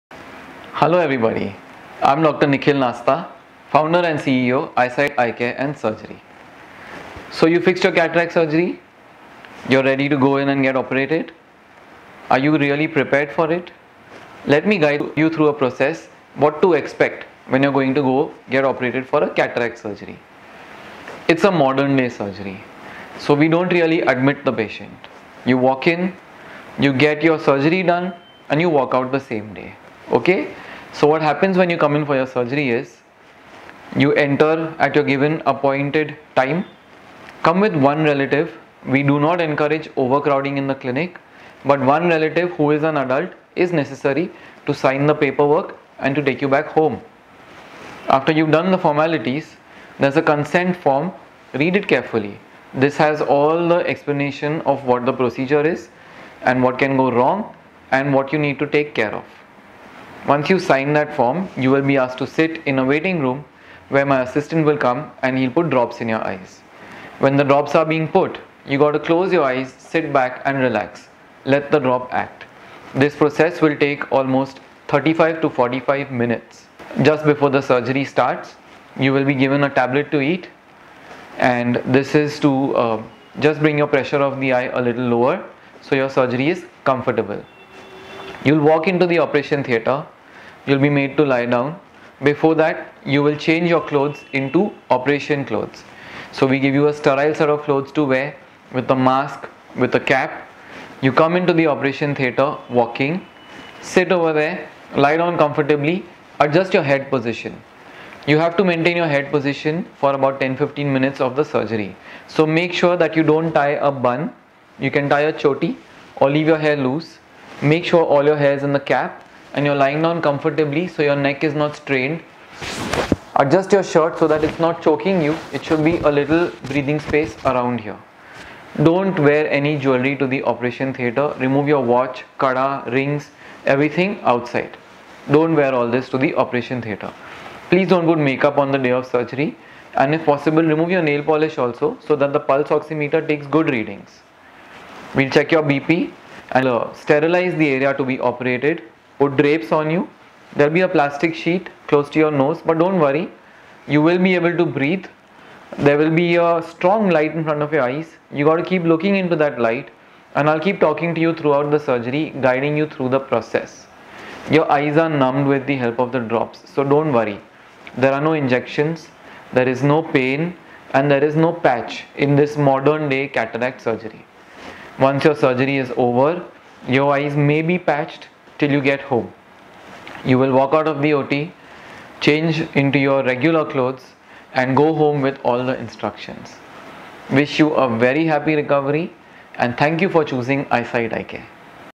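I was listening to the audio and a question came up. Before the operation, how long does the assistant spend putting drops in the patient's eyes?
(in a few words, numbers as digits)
35 to 45 minutes.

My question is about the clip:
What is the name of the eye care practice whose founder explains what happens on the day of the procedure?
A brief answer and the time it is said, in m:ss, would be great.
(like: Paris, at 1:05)
iSight Eye Care and Surgery, at 0:04.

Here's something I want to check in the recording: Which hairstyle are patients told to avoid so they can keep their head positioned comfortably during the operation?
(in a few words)
a bun.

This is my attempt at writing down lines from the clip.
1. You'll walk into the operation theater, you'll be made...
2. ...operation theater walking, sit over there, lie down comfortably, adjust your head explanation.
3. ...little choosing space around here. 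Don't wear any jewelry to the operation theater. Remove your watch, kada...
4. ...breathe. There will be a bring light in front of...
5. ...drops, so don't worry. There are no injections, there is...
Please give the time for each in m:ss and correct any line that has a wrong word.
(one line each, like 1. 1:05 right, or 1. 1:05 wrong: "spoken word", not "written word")
1. 1:28 right
2. 1:41 wrong: "position", not "explanation"
3. 2:06 wrong: "breathing", not "choosing"
4. 2:34 wrong: "strong", not "bring"
5. 2:46 right.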